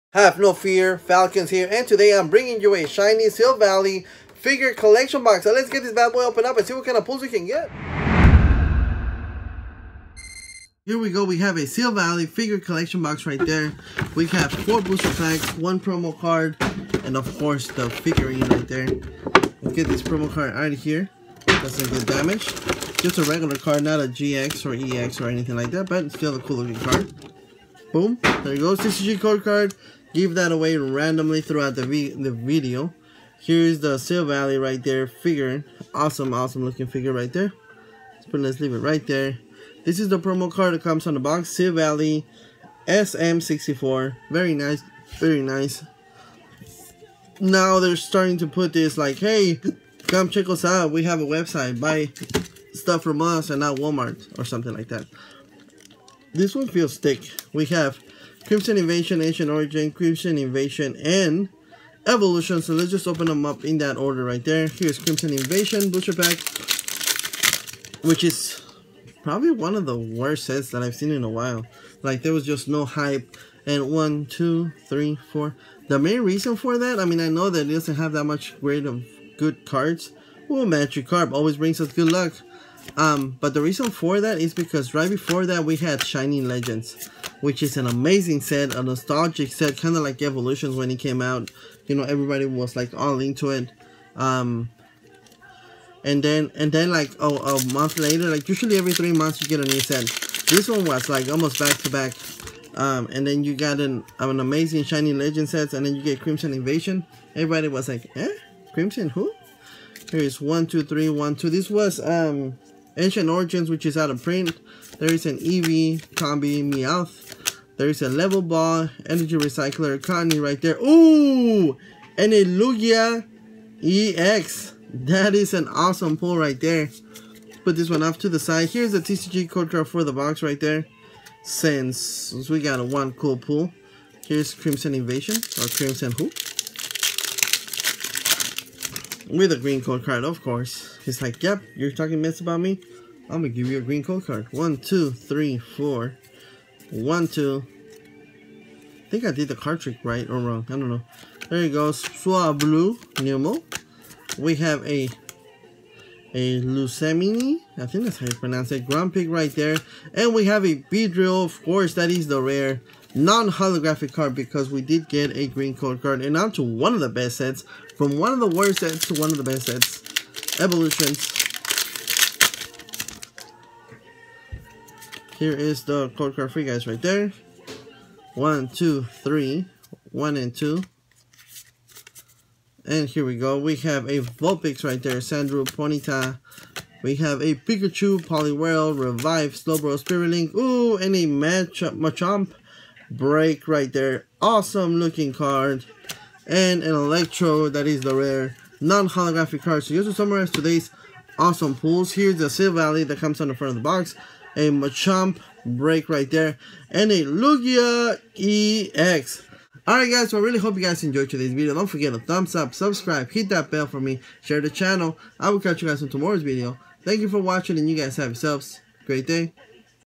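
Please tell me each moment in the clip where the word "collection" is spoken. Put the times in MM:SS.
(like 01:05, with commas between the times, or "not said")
00:04, 00:12.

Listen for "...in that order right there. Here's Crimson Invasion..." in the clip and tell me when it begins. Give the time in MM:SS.
01:03.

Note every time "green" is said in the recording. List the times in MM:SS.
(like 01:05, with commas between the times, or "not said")
02:19, 02:23, 02:45.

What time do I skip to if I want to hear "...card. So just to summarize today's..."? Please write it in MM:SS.
03:19.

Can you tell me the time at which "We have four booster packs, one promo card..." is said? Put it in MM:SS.
00:14.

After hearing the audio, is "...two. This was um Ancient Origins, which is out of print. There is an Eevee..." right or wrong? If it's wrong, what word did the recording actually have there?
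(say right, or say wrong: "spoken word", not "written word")
right.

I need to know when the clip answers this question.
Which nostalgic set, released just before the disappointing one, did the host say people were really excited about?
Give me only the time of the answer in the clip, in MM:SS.
01:26.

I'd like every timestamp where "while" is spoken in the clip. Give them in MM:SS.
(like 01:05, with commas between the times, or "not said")
01:11.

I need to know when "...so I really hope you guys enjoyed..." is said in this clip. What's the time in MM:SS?
03:30.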